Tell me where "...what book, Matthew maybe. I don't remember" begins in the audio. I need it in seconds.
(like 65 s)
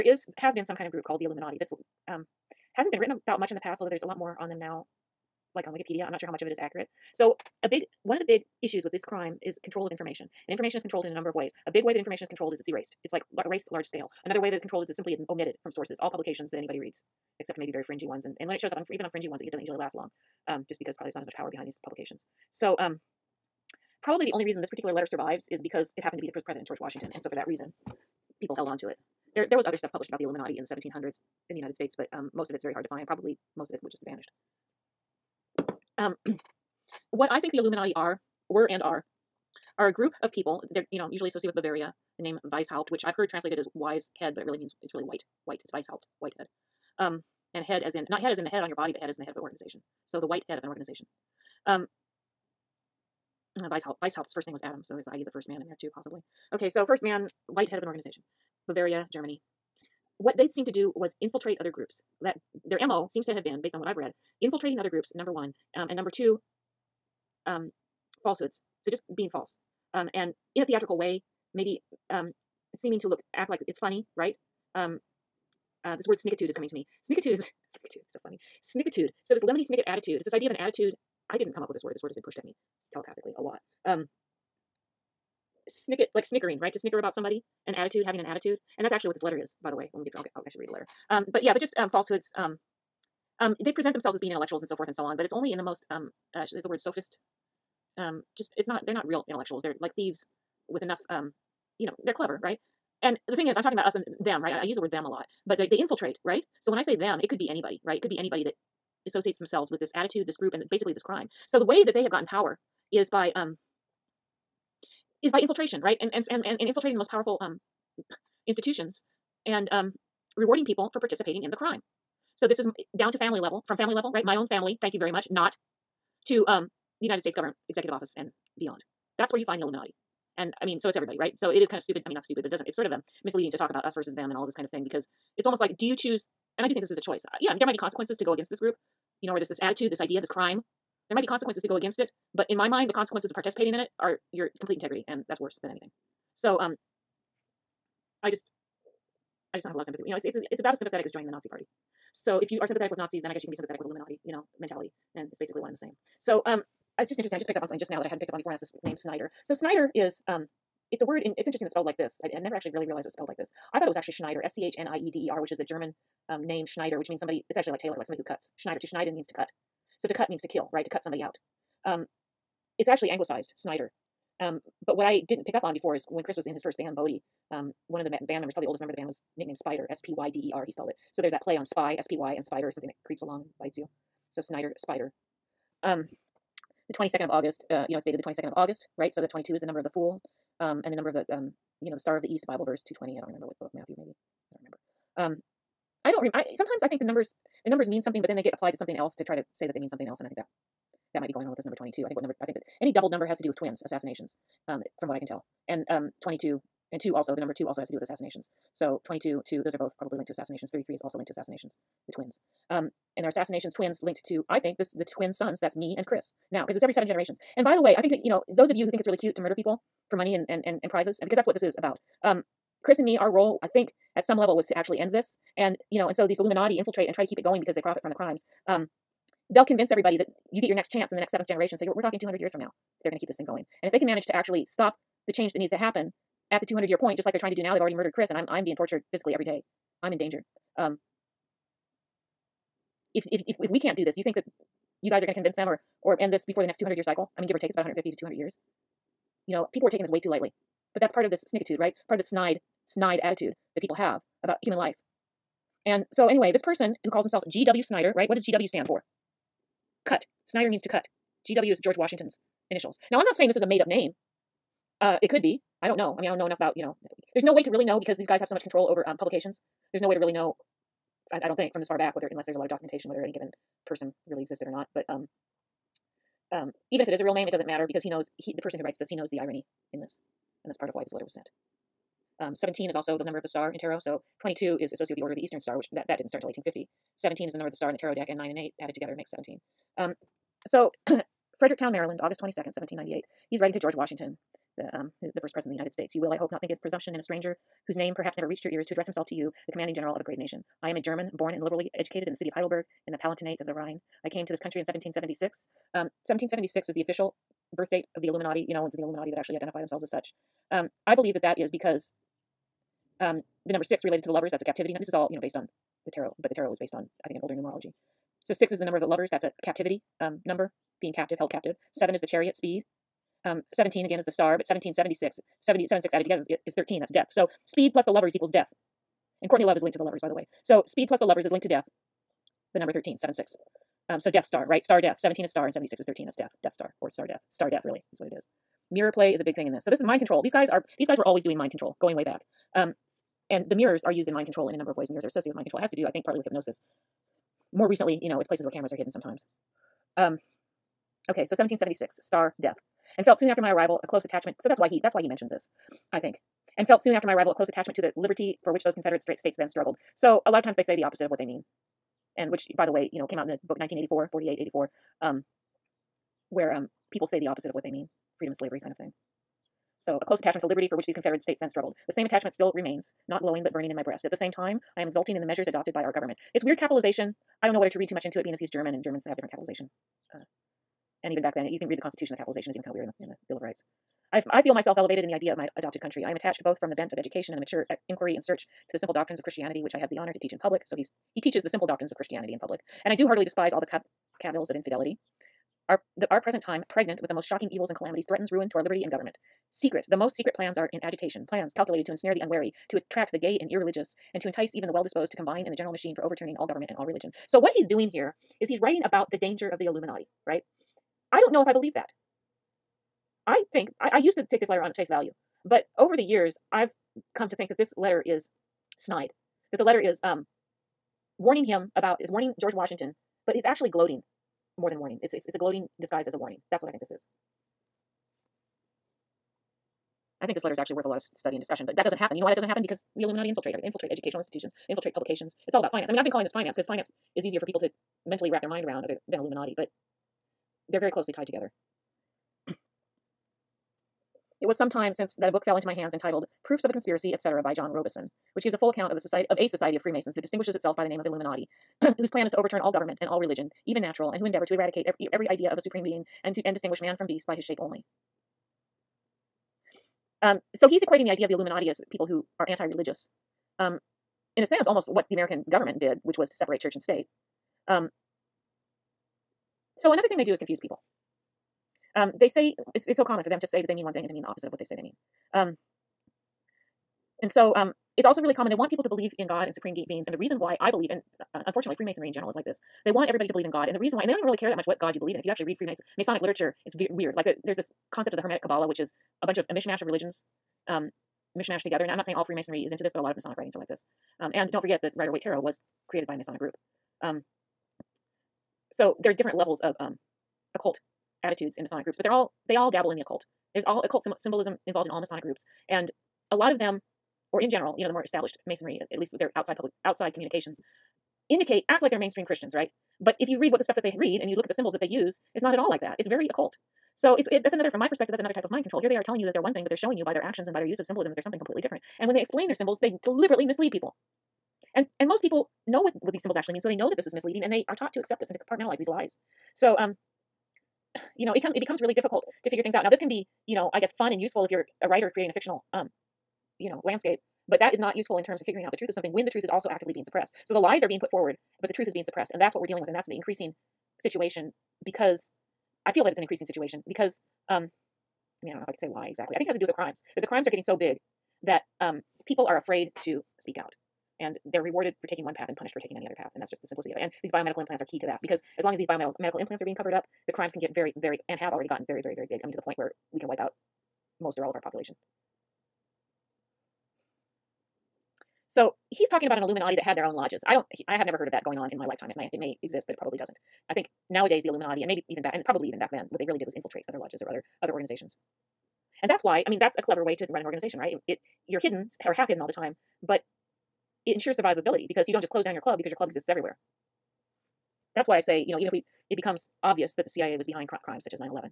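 193 s.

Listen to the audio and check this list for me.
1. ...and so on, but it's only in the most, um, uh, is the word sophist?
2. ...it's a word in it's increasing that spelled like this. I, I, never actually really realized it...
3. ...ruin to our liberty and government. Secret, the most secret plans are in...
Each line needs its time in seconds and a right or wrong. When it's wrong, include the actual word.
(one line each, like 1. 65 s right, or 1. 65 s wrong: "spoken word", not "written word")
1. 94 s right
2. 160 s wrong: "interesting", not "increasing"
3. 398 s right.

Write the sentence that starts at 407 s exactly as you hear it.
So, what he's doing here is he's writing about the danger of the Illuminati, right?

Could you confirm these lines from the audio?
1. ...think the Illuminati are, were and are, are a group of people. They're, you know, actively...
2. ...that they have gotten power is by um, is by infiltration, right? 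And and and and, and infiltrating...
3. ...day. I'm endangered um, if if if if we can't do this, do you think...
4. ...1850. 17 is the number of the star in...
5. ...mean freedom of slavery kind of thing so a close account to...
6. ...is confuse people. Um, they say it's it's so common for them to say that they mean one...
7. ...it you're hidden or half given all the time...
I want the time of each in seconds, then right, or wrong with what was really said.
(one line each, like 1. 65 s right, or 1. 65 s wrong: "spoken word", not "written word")
1. 37 s wrong: "usually", not "actively"
2. 111 s right
3. 239 s right
4. 286 s right
5. 367 s wrong: "attachment", not "account"
6. 470 s right
7. 581 s wrong: "hidden", not "given".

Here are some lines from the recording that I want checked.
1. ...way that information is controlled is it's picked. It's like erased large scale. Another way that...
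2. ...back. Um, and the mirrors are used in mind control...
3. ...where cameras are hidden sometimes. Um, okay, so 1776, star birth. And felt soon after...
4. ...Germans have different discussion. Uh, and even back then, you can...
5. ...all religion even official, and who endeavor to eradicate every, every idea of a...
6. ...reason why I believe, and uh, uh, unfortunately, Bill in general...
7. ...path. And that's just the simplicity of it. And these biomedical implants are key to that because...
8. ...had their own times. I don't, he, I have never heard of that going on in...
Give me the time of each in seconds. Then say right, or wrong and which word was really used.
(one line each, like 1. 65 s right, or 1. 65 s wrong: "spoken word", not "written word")
1. 11 s wrong: "erased", not "picked"
2. 342 s right
3. 348 s wrong: "death", not "birth"
4. 379 s wrong: "capitalization", not "discussion"
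5. 453 s wrong: "natural", not "official"
6. 480 s wrong: "Freemasonry", not "Bill"
7. 556 s right
8. 570 s wrong: "lodges", not "times".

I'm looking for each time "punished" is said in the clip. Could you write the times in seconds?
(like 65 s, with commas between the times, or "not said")
555 s.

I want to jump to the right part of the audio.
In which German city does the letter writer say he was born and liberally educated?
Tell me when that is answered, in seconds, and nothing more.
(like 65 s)
302 s.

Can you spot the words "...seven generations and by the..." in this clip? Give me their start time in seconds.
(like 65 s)
216 s.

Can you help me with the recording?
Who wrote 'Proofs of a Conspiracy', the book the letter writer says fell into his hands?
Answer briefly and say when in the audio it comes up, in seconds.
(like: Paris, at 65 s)
John Robeson, at 447 s.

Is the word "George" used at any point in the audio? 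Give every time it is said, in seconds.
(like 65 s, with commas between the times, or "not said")
26 s, 261 s, 293 s, 422 s.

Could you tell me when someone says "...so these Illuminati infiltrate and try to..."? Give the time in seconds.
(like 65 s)
226 s.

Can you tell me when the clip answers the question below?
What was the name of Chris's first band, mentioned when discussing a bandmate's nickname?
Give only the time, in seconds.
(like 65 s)
176 s.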